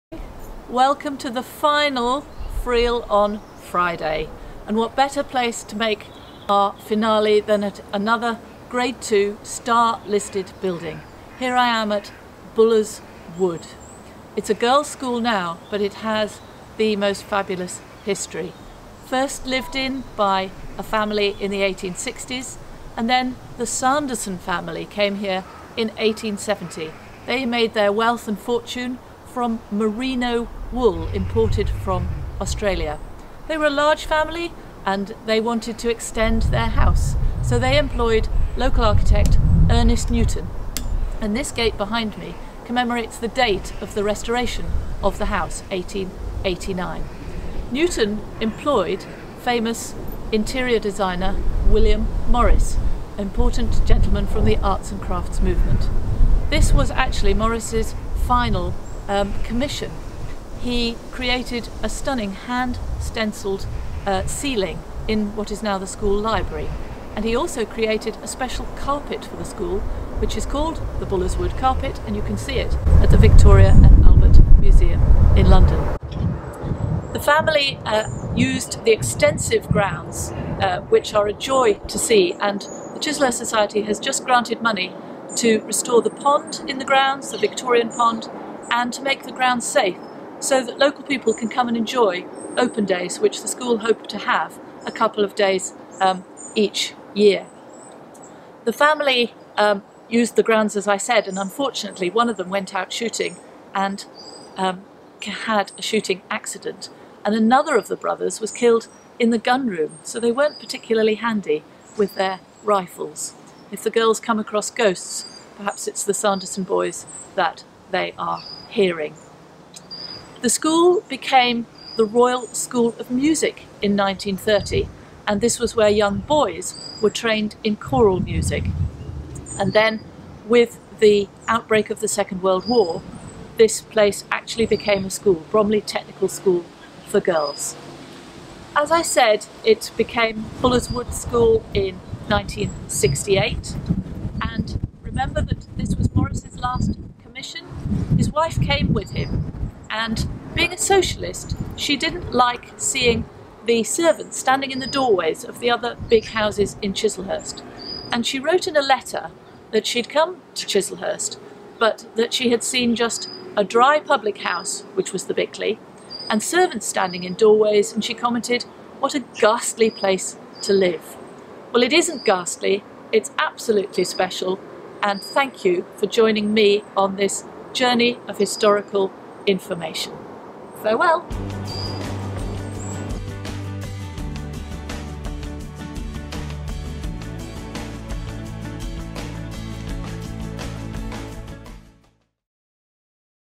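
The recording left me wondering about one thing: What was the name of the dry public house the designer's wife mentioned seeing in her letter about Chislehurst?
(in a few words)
The Bickley.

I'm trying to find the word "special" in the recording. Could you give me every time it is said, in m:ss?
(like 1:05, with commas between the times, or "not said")
1:08, 2:54.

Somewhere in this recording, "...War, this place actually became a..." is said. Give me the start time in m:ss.
2:12.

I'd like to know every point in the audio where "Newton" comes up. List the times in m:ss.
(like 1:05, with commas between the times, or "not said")
0:40, 0:47.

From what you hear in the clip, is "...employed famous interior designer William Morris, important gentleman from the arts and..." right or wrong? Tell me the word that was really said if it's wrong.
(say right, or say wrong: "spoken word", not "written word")
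right.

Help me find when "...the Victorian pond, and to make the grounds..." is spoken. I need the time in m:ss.
1:27.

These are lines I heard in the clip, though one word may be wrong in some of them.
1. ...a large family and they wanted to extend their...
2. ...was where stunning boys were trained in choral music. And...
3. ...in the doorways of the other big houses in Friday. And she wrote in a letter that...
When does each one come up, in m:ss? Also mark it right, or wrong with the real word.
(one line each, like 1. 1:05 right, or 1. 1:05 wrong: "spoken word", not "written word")
1. 0:33 right
2. 2:05 wrong: "young", not "stunning"
3. 2:34 wrong: "Chislehurst", not "Friday".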